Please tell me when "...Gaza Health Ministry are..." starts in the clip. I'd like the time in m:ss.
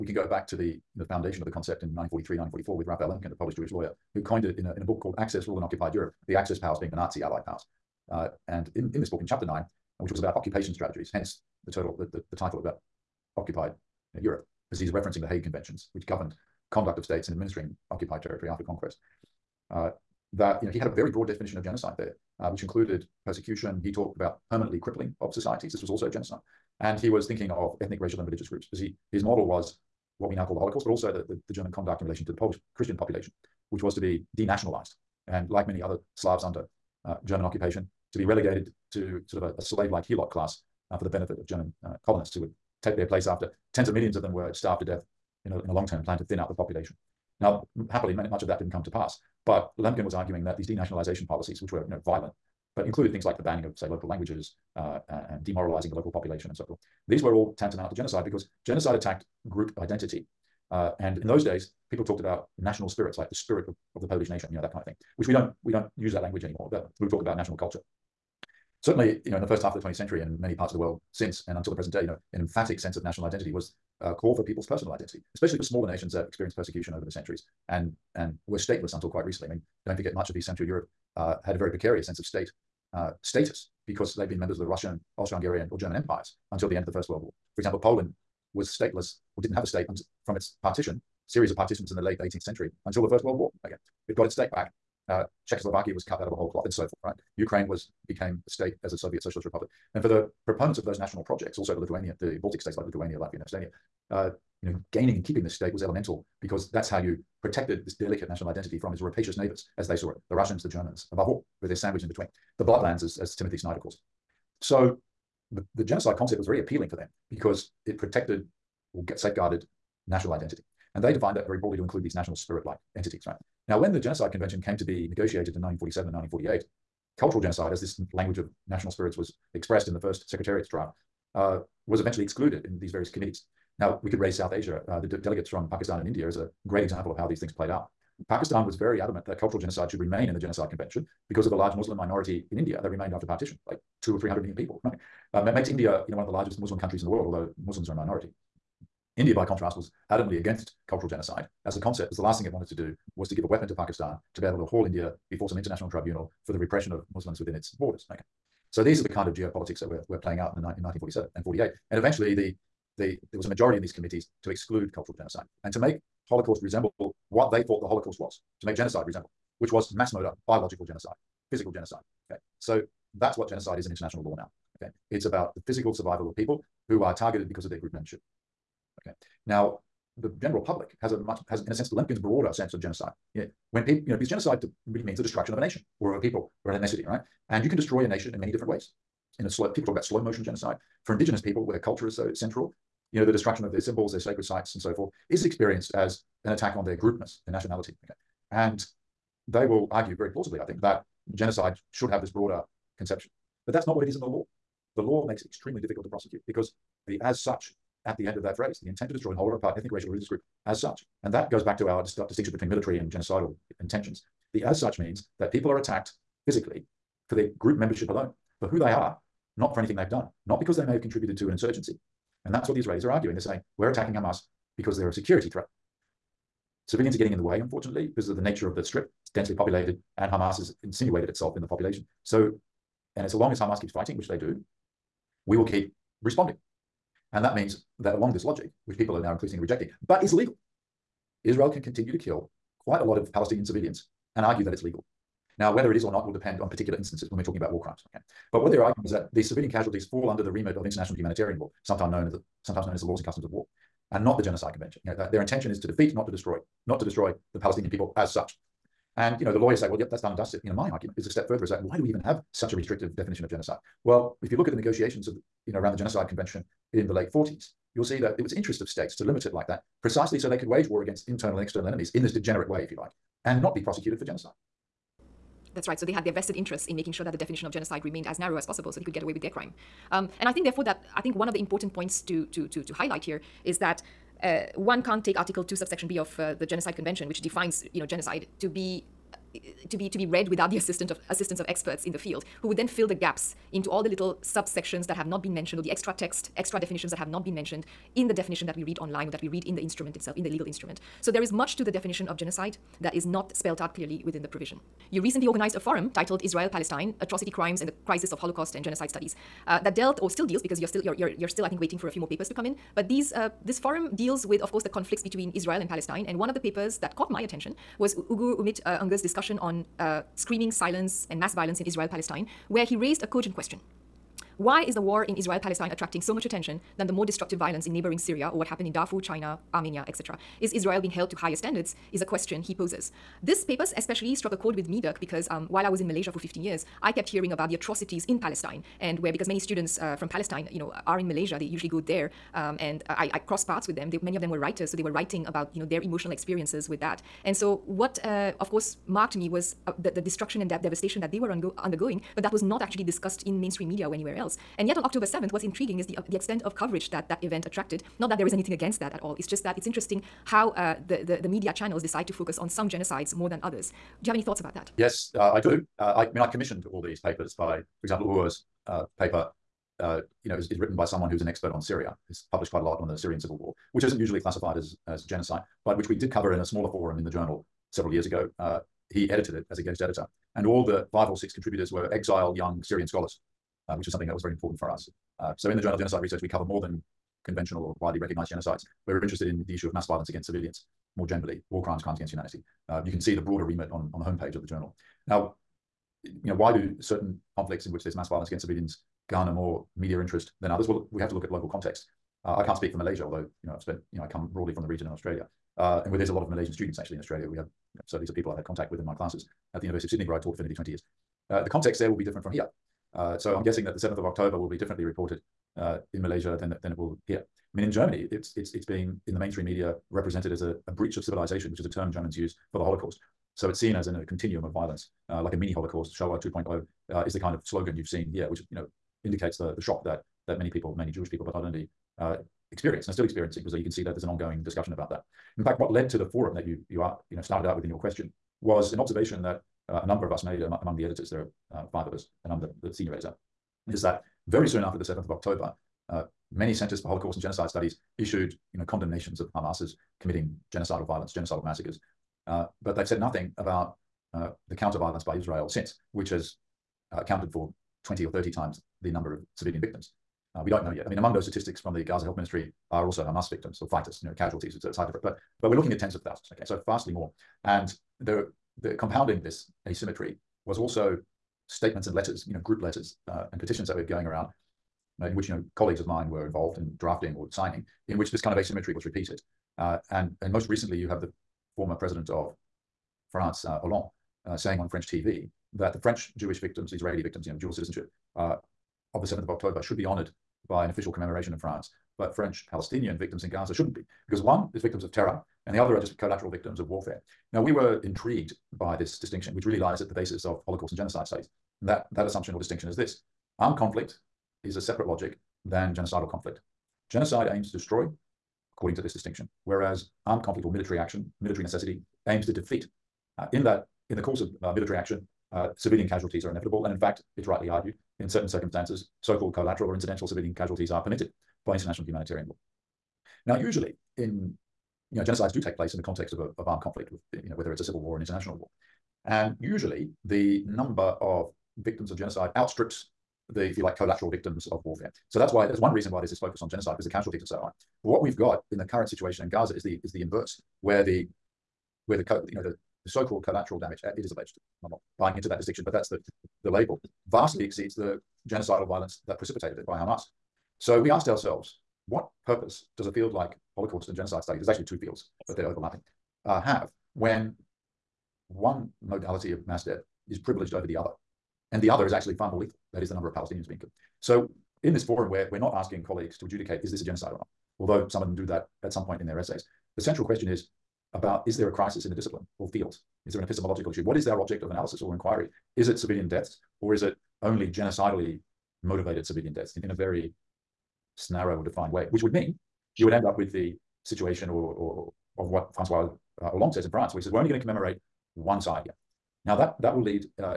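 7:42.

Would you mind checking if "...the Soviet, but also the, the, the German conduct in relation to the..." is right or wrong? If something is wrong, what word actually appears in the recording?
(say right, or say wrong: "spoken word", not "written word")
wrong: "Holocaust", not "Soviet".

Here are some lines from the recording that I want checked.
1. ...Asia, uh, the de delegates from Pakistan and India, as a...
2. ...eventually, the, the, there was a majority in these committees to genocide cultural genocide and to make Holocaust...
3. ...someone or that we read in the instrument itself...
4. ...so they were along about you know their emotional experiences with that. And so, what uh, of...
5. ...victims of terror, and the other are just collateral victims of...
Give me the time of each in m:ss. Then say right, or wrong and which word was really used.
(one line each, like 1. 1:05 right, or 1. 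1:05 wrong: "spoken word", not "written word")
1. 2:14 right
2. 2:41 wrong: "exclude", not "genocide"
3. 4:58 wrong: "online", not "someone"
4. 5:44 wrong: "writing", not "along"
5. 8:14 right.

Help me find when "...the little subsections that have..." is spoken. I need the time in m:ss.
4:54.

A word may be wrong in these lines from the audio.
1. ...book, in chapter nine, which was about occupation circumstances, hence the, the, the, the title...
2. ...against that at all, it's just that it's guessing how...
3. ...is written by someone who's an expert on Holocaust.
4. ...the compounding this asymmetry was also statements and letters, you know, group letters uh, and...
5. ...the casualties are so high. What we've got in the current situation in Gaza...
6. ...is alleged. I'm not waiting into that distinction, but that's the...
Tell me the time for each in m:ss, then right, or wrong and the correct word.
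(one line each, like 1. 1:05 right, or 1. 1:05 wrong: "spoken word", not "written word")
1. 0:09 wrong: "strategies", not "circumstances"
2. 5:58 wrong: "interesting", not "guessing"
3. 6:10 wrong: "Syria", not "Holocaust"
4. 7:48 right
5. 8:57 right
6. 9:04 wrong: "buying", not "waiting".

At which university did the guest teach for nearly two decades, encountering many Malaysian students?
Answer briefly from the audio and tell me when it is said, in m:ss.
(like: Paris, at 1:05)
University of Sydney, at 6:49.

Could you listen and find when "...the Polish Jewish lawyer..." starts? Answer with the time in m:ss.
0:03.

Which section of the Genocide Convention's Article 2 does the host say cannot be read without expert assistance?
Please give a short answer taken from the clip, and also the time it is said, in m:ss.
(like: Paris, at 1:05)
subsection B, at 4:45.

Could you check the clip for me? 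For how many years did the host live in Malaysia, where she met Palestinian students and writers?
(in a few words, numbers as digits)
15.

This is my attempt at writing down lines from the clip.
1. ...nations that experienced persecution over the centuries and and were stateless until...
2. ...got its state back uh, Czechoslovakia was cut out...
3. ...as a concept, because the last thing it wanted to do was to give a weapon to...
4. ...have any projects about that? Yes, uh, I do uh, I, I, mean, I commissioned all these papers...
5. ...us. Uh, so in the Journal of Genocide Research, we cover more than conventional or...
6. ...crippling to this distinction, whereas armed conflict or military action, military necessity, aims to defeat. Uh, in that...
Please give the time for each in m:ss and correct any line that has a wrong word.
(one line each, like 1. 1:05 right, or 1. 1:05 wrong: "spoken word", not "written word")
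1. 1:15 right
2. 1:34 right
3. 2:31 right
4. 6:04 wrong: "thoughts", not "projects"
5. 6:24 right
6. 8:28 wrong: "according", not "crippling".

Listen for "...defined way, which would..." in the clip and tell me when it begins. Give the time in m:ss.
9:41.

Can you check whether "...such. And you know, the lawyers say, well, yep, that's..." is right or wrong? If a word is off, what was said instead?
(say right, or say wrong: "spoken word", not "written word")
right.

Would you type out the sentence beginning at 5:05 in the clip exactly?
You recently organized a forum titled Israel Palestine Atrocity Crimes and the Crisis of Holocaust and Genocide Studies.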